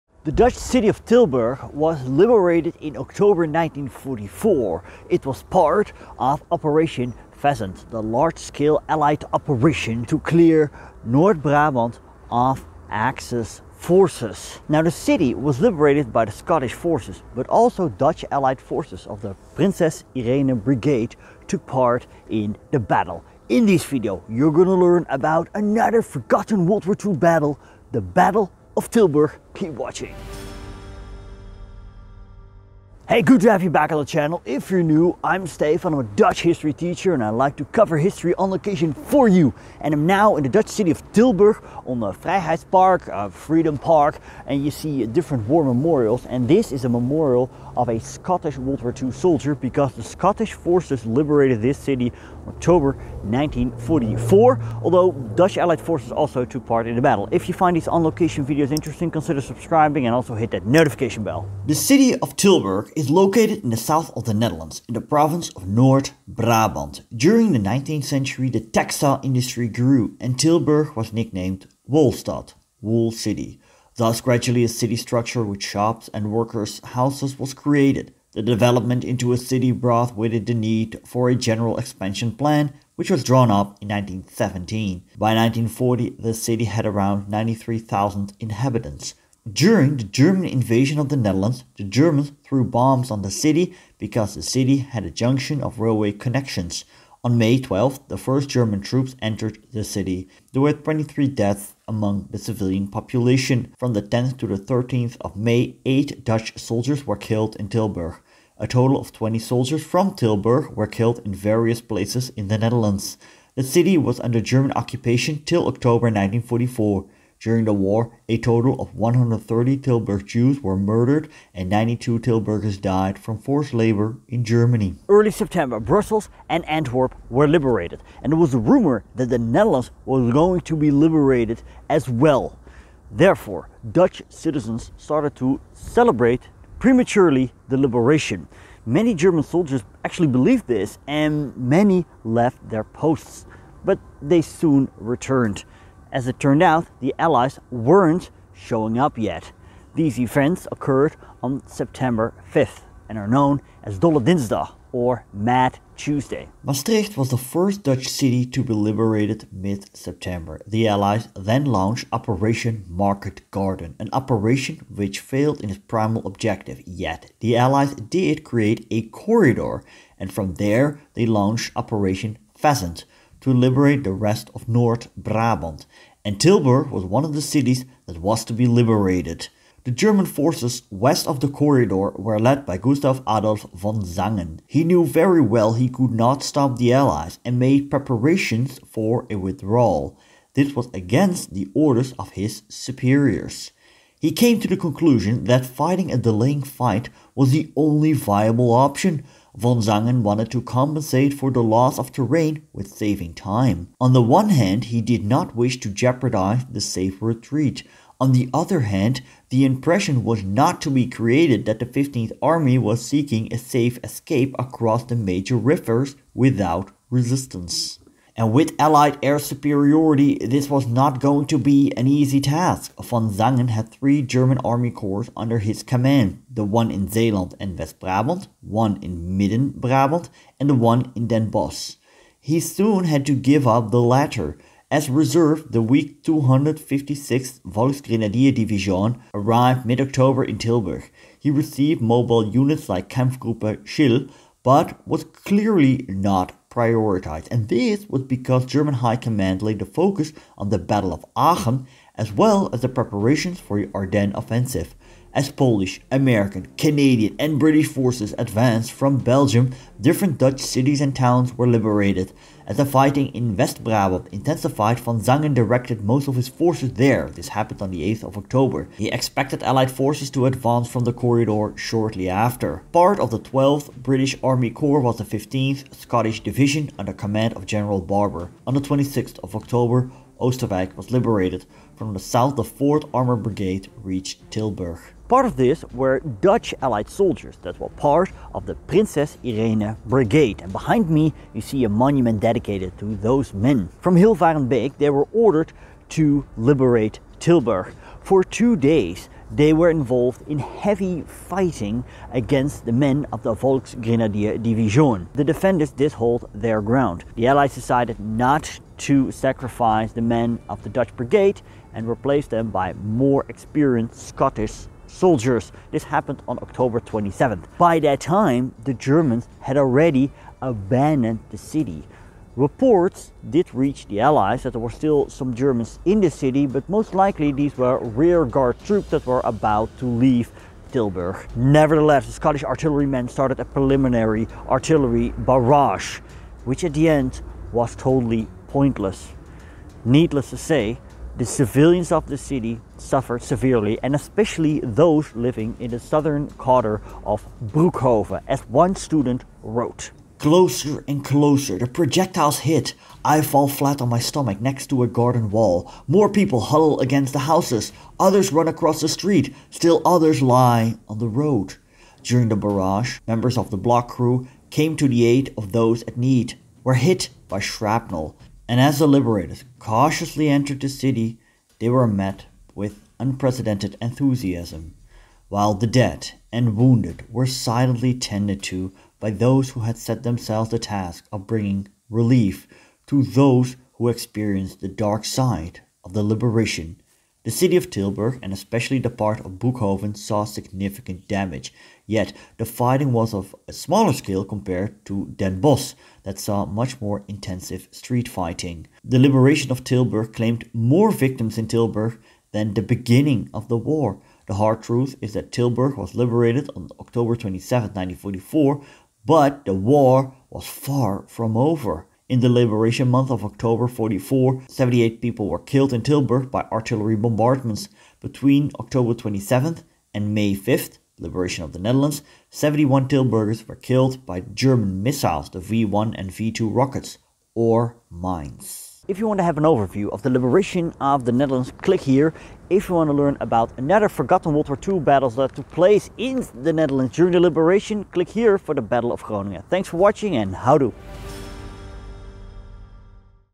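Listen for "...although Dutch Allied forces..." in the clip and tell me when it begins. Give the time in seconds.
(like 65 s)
54 s.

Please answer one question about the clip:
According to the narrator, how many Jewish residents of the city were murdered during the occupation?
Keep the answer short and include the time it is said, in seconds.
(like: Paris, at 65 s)
130, at 118 s.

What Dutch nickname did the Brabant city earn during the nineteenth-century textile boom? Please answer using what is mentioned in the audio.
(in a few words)
Wolstad.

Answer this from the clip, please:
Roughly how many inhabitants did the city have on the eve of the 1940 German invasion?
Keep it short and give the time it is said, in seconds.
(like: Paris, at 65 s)
93,000, at 87 s.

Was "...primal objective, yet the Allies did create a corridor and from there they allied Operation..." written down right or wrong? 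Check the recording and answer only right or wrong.
wrong.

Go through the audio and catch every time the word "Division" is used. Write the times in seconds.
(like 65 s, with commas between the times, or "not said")
238 s, 276 s, 304 s.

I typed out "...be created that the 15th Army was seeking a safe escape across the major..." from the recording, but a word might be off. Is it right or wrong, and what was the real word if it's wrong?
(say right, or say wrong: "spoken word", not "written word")
right.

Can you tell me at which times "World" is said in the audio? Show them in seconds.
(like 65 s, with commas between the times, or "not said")
26 s, 48 s, 434 s.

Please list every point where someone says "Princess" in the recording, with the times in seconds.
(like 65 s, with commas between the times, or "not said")
19 s, 288 s.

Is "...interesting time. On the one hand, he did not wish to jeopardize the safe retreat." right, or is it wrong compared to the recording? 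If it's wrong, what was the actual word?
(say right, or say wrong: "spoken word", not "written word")
wrong: "saving", not "interesting".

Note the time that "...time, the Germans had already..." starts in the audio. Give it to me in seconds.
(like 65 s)
318 s.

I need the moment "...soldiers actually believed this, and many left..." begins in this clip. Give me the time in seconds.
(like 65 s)
139 s.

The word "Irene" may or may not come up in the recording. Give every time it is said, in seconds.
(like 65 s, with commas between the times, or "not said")
20 s, 289 s.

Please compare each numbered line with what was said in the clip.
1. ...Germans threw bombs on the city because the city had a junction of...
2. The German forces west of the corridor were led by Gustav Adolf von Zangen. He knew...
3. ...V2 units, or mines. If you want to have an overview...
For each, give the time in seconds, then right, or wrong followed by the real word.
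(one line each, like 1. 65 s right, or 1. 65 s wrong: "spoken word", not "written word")
1. 91 s right
2. 179 s right
3. 426 s wrong: "rockets", not "units".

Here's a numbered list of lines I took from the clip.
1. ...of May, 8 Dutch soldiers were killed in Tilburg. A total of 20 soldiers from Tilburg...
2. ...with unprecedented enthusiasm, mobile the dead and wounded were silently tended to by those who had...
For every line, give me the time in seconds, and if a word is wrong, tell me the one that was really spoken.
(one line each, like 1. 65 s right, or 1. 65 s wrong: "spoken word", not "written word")
1. 105 s right
2. 372 s wrong: "while", not "mobile".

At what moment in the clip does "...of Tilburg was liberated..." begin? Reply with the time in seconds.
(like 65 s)
0 s.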